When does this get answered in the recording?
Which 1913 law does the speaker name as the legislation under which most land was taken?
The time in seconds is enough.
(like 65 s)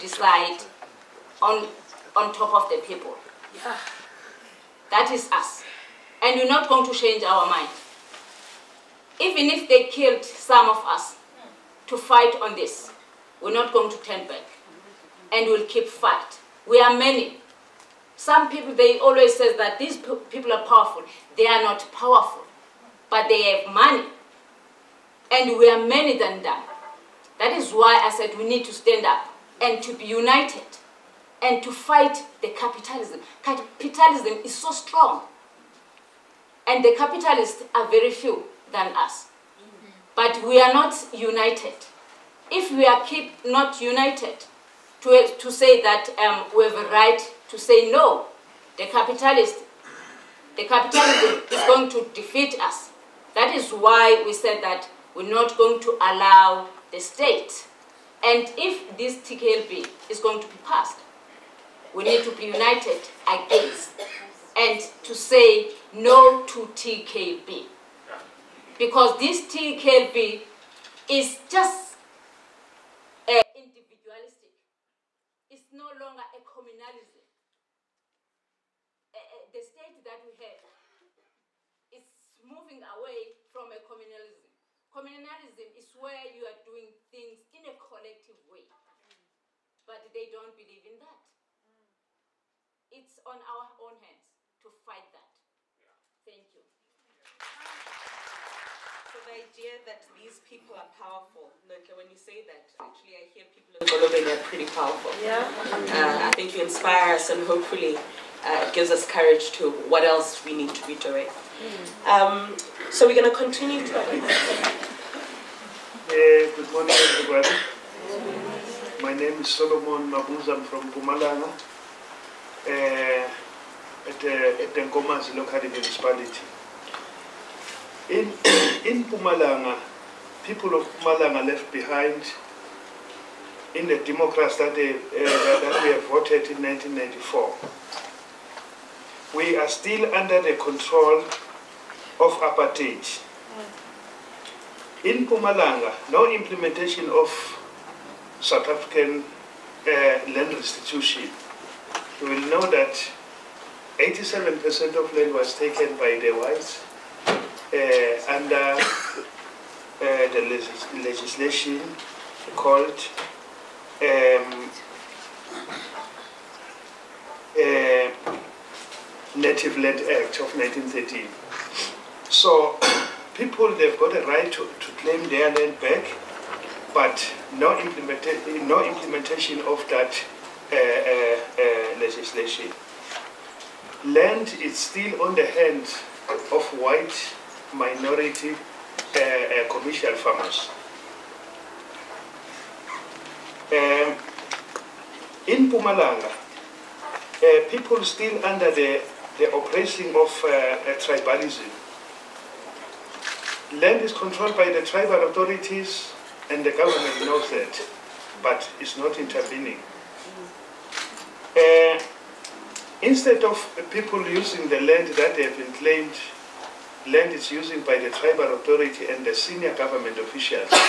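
169 s.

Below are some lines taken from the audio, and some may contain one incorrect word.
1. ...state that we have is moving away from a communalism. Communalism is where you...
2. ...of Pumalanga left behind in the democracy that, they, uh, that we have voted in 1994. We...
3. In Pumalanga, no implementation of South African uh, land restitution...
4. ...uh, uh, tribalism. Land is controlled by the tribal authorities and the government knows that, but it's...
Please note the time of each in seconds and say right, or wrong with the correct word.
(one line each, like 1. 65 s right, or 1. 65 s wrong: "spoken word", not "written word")
1. 79 s right
2. 130 s right
3. 145 s right
4. 200 s right.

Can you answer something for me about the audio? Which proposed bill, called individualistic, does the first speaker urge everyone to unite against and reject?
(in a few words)
TKLB.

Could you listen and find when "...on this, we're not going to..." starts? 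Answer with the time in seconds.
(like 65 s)
12 s.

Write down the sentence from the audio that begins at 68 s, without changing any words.
Because this TKB is just uh, individualistic.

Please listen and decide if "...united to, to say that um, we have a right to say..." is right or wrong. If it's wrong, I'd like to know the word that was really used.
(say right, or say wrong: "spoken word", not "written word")
right.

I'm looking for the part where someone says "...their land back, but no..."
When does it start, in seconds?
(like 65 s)
175 s.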